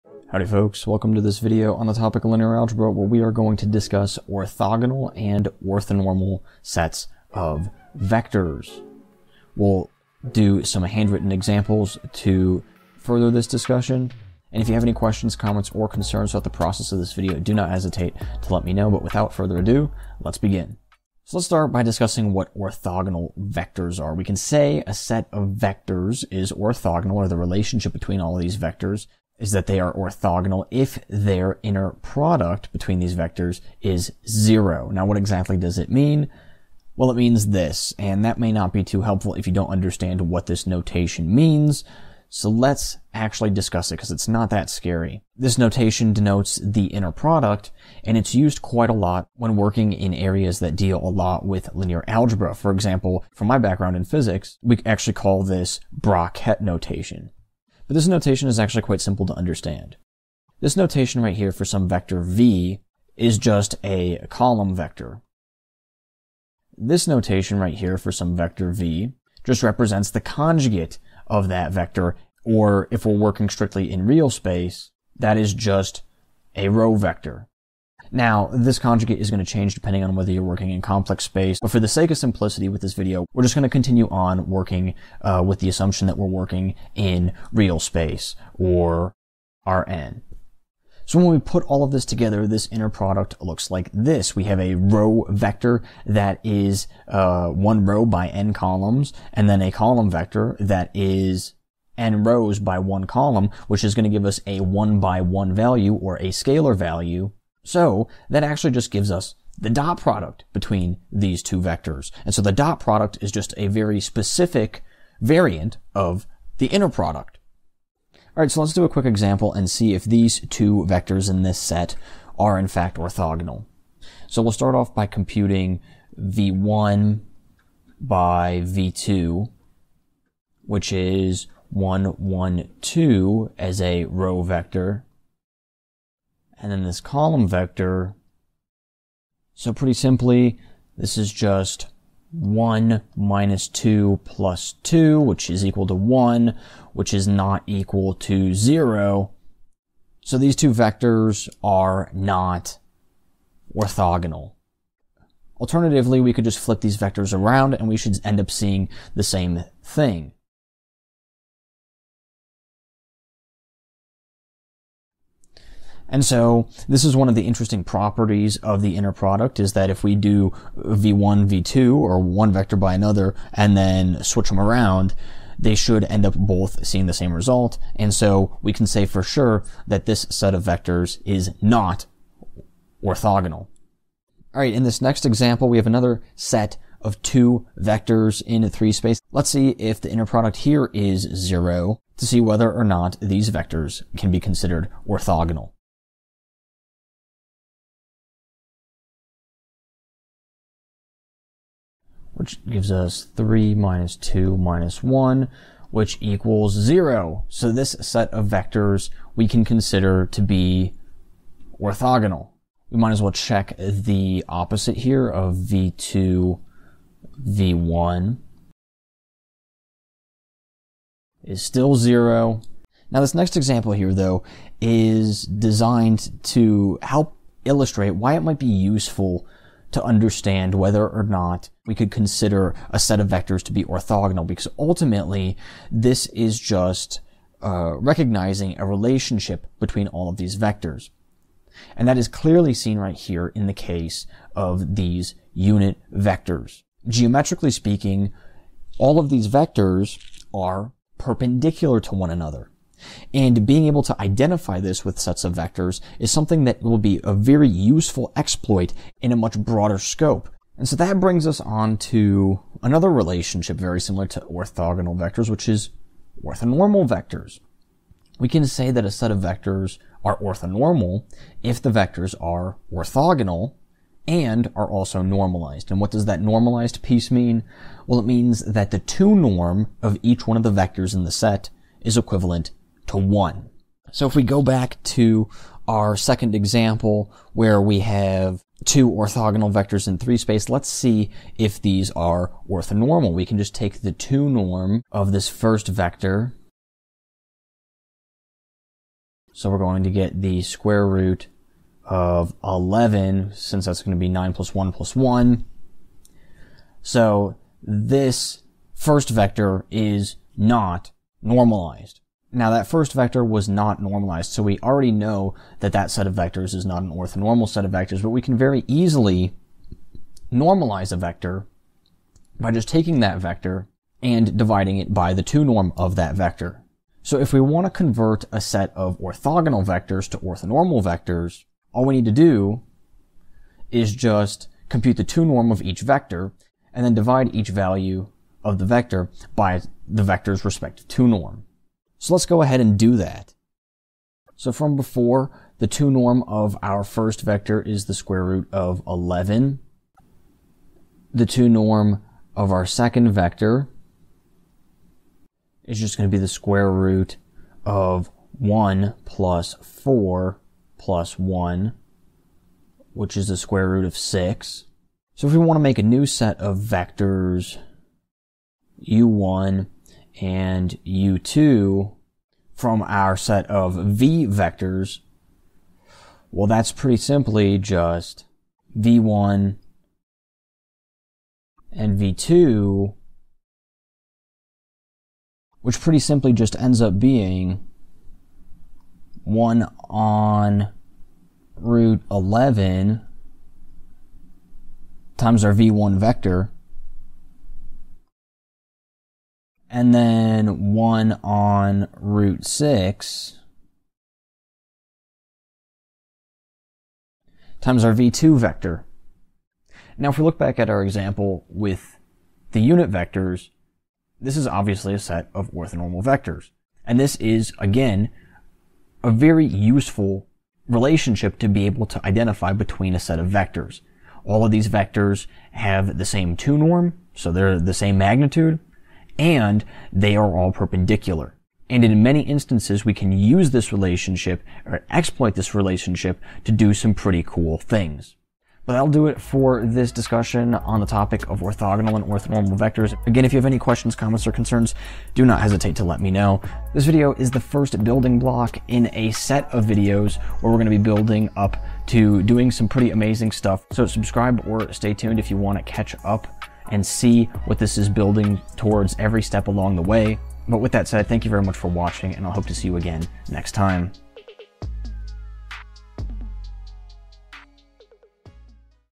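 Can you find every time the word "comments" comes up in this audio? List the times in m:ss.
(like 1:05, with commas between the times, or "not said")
0:15, 7:24.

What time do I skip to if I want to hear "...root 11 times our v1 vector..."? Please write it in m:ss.
6:31.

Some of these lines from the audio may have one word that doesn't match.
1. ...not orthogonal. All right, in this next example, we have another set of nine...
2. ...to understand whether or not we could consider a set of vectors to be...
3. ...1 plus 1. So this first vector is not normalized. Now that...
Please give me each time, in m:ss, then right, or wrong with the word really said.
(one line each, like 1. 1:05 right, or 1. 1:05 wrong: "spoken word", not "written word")
1. 3:01 wrong: "two", not "nine"
2. 3:49 right
3. 5:04 right.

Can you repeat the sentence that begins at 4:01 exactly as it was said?
And that is clearly seen right here in the case of these unit vectors.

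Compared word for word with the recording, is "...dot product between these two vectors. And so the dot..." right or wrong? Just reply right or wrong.
right.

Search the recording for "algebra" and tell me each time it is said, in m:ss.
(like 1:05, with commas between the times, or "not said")
0:02, 0:52.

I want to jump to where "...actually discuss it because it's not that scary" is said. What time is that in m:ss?
0:43.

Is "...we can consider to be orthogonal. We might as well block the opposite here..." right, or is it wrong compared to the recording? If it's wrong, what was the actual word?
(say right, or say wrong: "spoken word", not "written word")
wrong: "check", not "block".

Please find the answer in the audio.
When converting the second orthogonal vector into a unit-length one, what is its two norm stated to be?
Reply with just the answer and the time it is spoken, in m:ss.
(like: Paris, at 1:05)
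square root of 6, at 6:03.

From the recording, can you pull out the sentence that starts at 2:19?
So pretty simply, this is just 1 minus 2 plus 2, which is equal to 1, which is not equal to 0.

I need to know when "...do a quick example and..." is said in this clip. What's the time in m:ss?
1:58.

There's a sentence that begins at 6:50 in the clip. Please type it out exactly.
Now, if we look back at our example with the unit vectors, this is obviously a set of orthonormal vectors.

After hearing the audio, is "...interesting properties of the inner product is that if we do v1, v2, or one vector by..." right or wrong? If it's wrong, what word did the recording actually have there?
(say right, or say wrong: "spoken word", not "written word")
right.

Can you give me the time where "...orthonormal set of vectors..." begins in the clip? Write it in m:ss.
5:17.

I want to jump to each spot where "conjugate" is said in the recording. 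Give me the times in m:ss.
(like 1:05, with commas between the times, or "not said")
1:10, 1:18.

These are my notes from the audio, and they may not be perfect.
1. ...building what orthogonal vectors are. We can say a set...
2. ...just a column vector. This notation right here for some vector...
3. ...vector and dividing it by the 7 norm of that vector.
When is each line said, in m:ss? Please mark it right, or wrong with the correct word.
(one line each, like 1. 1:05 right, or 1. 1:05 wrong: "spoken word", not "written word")
1. 0:21 wrong: "discussing", not "building"
2. 1:03 right
3. 5:23 wrong: "2", not "7".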